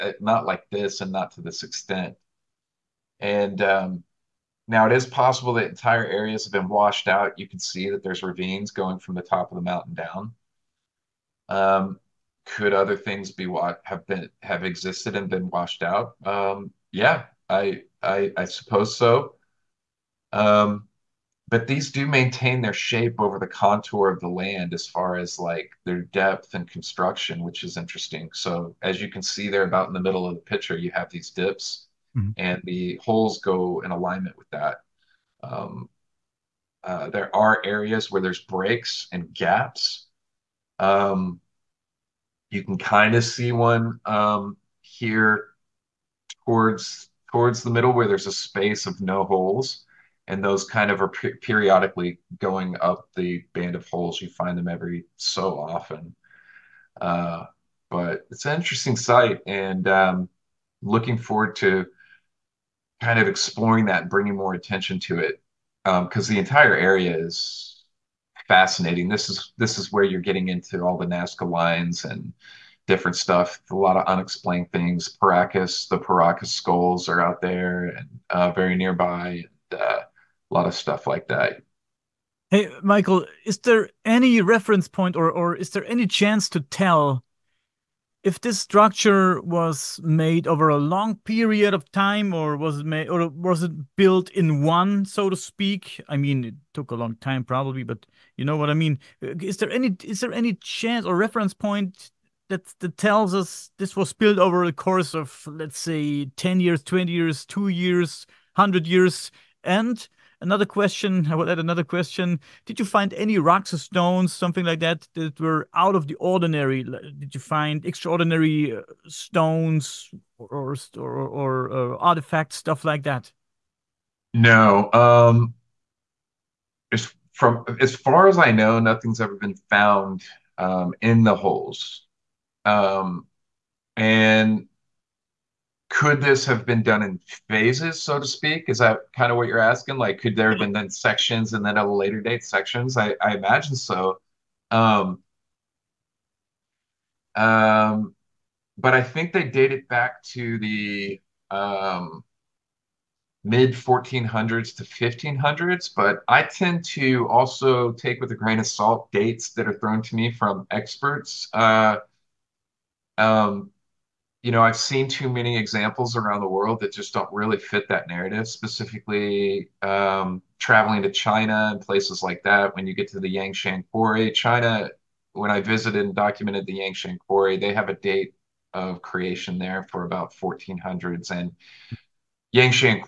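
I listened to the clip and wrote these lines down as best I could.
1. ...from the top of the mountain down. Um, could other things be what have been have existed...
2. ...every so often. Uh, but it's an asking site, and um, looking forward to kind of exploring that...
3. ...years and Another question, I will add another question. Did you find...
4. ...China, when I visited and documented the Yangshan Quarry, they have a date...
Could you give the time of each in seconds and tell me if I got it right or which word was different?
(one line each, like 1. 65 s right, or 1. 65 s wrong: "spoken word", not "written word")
1. 8 s right
2. 54 s wrong: "interesting", not "asking"
3. 108 s right
4. 174 s right.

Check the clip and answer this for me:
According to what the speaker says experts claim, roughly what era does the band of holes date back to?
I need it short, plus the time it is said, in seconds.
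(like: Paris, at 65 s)
mid 1400s to 1500s, at 153 s.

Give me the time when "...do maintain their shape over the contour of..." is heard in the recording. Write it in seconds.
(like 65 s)
21 s.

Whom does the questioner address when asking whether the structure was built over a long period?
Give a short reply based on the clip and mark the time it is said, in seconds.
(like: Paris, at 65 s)
Michael, at 82 s.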